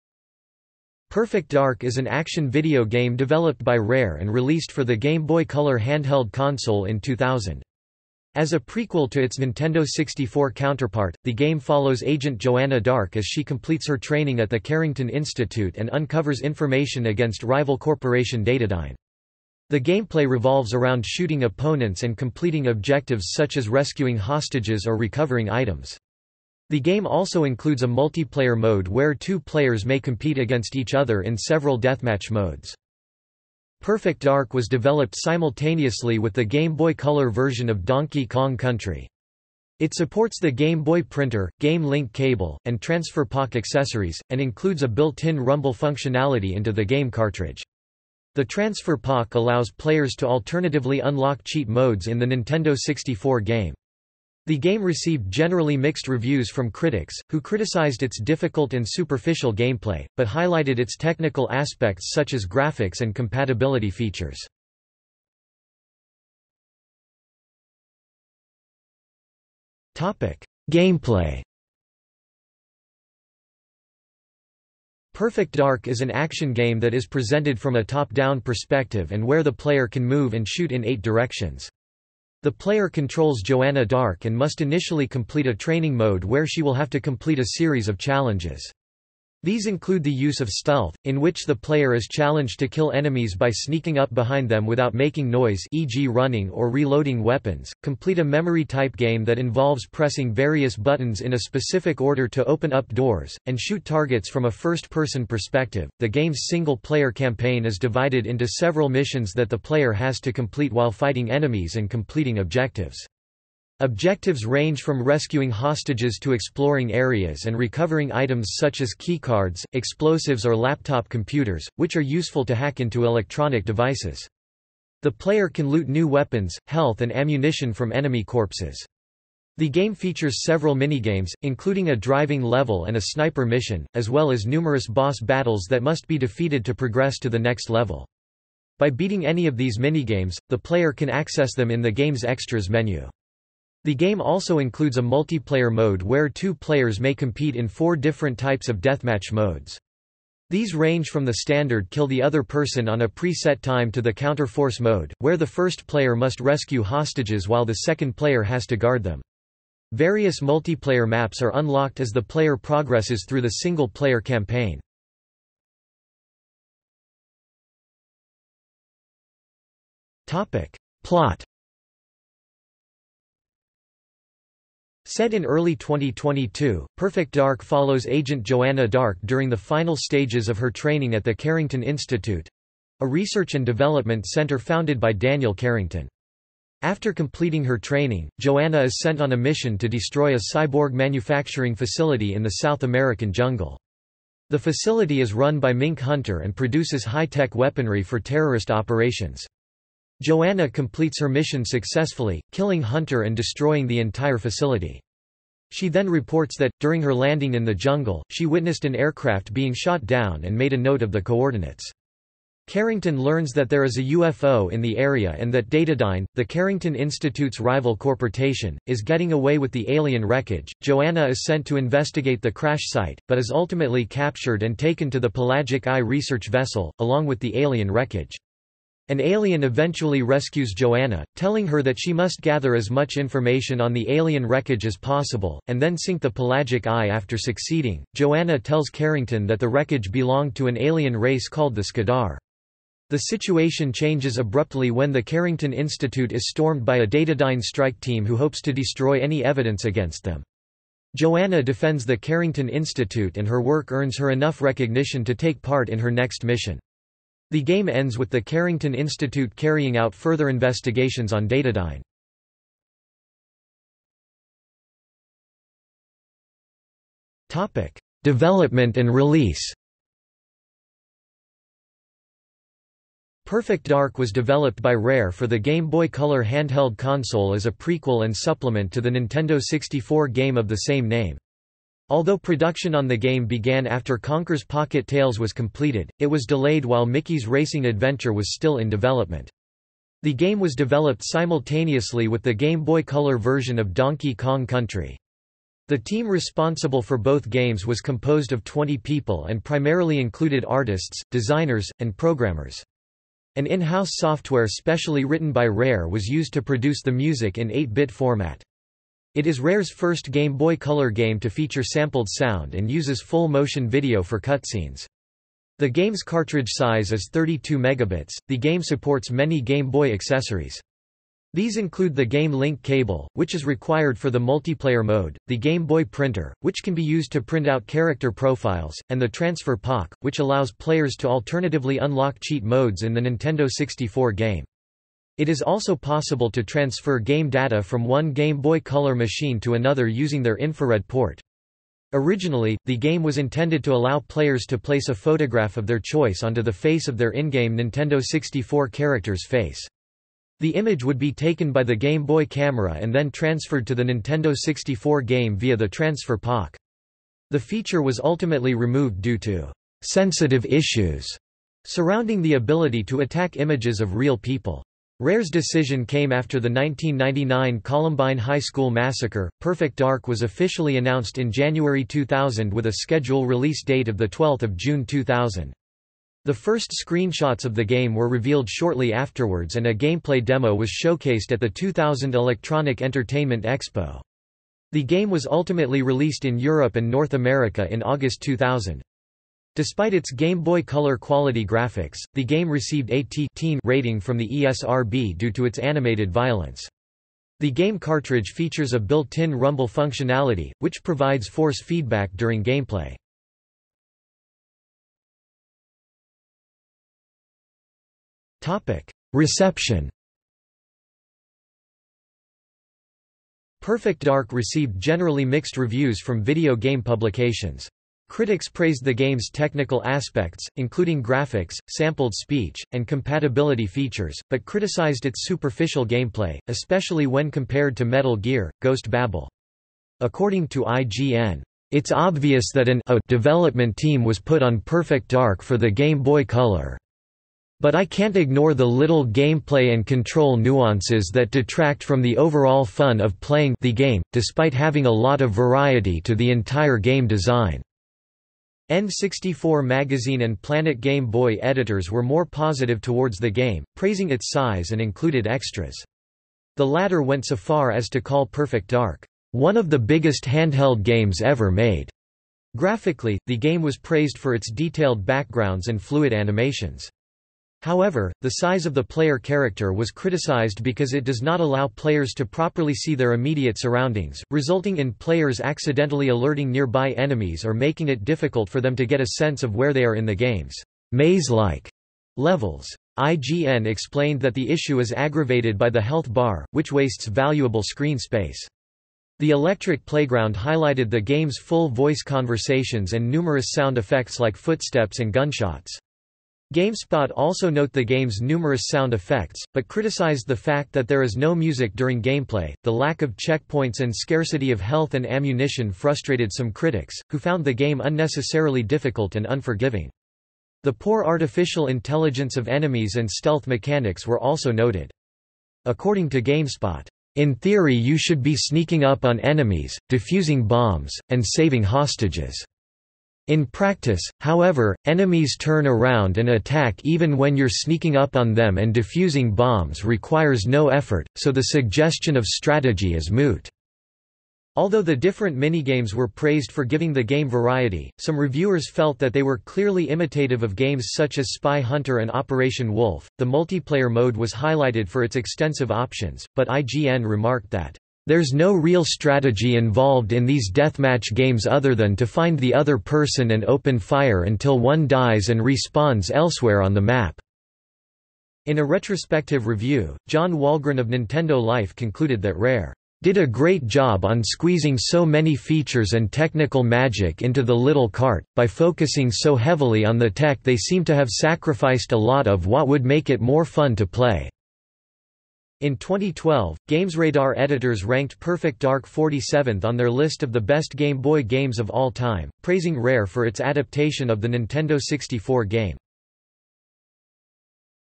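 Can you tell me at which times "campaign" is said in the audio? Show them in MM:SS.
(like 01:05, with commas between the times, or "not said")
01:47, 02:44.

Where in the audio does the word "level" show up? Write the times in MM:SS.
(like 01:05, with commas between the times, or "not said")
02:12, 02:17, 08:02.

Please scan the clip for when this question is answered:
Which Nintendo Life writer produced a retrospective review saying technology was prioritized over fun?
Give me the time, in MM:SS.
09:20.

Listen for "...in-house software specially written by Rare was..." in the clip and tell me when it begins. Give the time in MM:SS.
05:03.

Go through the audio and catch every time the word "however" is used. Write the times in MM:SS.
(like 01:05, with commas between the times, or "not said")
07:47, 08:44.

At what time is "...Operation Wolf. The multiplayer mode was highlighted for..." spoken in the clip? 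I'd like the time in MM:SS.
09:02.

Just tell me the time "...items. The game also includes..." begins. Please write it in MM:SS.
00:25.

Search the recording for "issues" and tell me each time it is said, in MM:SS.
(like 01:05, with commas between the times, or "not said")
06:00, 08:04.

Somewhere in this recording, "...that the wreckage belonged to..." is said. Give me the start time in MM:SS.
03:59.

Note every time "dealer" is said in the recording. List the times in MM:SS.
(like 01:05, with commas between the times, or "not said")
not said.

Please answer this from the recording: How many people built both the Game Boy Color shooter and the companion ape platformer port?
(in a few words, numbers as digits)
20.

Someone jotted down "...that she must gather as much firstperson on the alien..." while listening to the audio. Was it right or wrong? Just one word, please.
wrong.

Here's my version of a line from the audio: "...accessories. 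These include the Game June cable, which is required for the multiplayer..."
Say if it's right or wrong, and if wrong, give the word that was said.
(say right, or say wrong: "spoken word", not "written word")
wrong: "Link", not "June".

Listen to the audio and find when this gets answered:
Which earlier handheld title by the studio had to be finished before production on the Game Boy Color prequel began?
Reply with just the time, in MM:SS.
04:44.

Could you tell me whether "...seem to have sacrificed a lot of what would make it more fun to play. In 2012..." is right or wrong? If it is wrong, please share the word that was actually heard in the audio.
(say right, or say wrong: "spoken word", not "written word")
right.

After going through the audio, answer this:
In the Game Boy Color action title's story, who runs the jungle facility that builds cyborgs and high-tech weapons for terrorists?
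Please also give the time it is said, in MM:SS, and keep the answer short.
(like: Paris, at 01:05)
Mink Hunter, at 03:15.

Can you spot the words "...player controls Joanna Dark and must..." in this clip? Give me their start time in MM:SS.
01:22.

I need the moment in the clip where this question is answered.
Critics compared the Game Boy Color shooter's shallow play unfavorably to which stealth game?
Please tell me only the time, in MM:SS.
07:08.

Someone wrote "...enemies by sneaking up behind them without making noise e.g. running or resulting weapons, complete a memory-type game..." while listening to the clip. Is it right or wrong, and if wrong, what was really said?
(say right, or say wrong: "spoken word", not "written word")
wrong: "reloading", not "resulting".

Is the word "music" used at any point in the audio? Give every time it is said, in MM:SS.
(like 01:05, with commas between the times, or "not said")
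05:07, 08:21.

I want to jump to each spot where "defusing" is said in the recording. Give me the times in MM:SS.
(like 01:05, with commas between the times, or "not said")
08:40, 08:48.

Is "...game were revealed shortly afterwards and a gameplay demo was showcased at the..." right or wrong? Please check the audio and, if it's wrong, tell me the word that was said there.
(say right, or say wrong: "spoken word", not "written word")
right.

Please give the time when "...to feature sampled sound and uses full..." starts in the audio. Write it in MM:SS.
05:11.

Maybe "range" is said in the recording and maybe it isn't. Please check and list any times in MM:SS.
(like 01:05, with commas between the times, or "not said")
01:54, 02:30.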